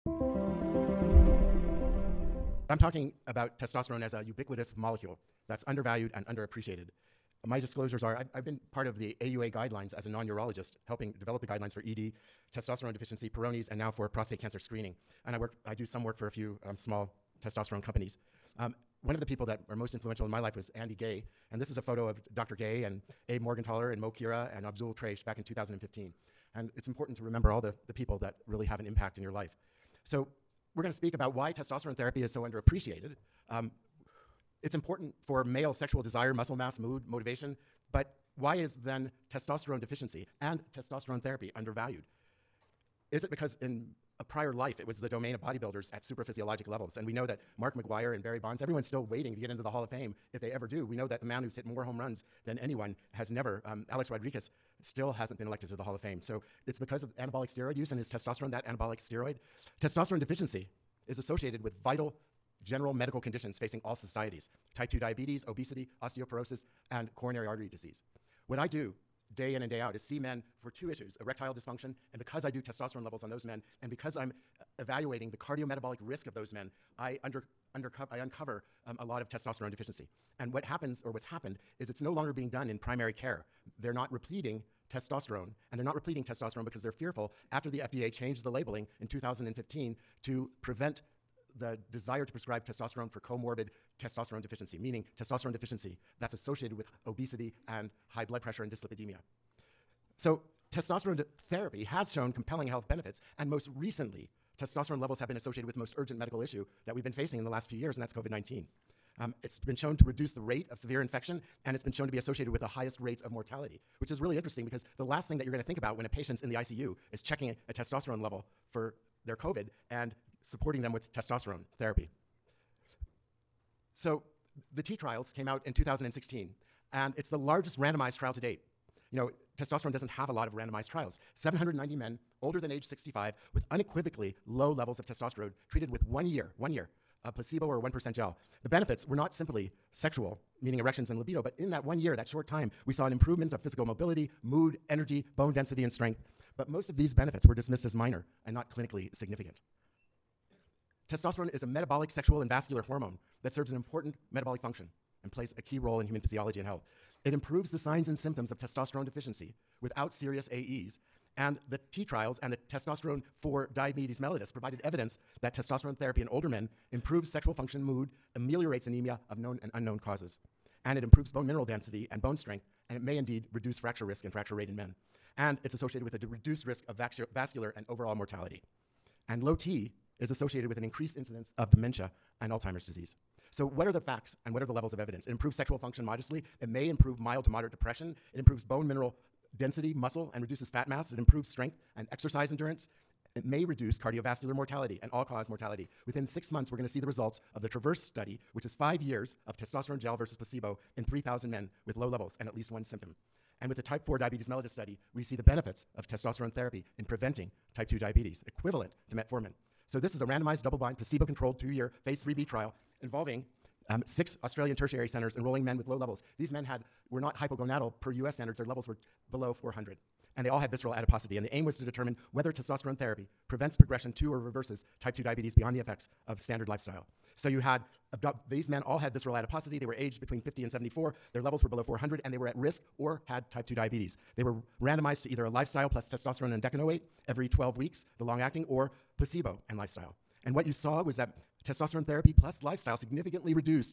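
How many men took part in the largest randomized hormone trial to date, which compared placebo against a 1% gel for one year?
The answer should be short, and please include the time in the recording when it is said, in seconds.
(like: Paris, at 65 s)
790, at 131 s.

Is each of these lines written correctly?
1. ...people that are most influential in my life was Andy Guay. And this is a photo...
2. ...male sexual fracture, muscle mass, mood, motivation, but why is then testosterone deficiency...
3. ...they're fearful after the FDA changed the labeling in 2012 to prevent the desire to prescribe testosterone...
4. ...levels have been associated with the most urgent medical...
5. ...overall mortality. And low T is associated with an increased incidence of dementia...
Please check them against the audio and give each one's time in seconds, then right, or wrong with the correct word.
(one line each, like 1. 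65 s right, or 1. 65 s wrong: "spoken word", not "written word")
1. 19 s right
2. 35 s wrong: "desire", not "fracture"
3. 86 s wrong: "2015", not "2012"
4. 104 s right
5. 177 s right.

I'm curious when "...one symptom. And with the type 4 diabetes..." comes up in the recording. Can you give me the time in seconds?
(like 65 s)
202 s.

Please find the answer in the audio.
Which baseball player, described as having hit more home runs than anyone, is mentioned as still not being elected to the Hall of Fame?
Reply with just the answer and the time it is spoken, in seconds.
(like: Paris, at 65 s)
Alex Rodriguez, at 53 s.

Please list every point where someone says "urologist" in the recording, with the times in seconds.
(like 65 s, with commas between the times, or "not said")
10 s.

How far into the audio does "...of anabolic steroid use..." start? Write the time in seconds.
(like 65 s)
57 s.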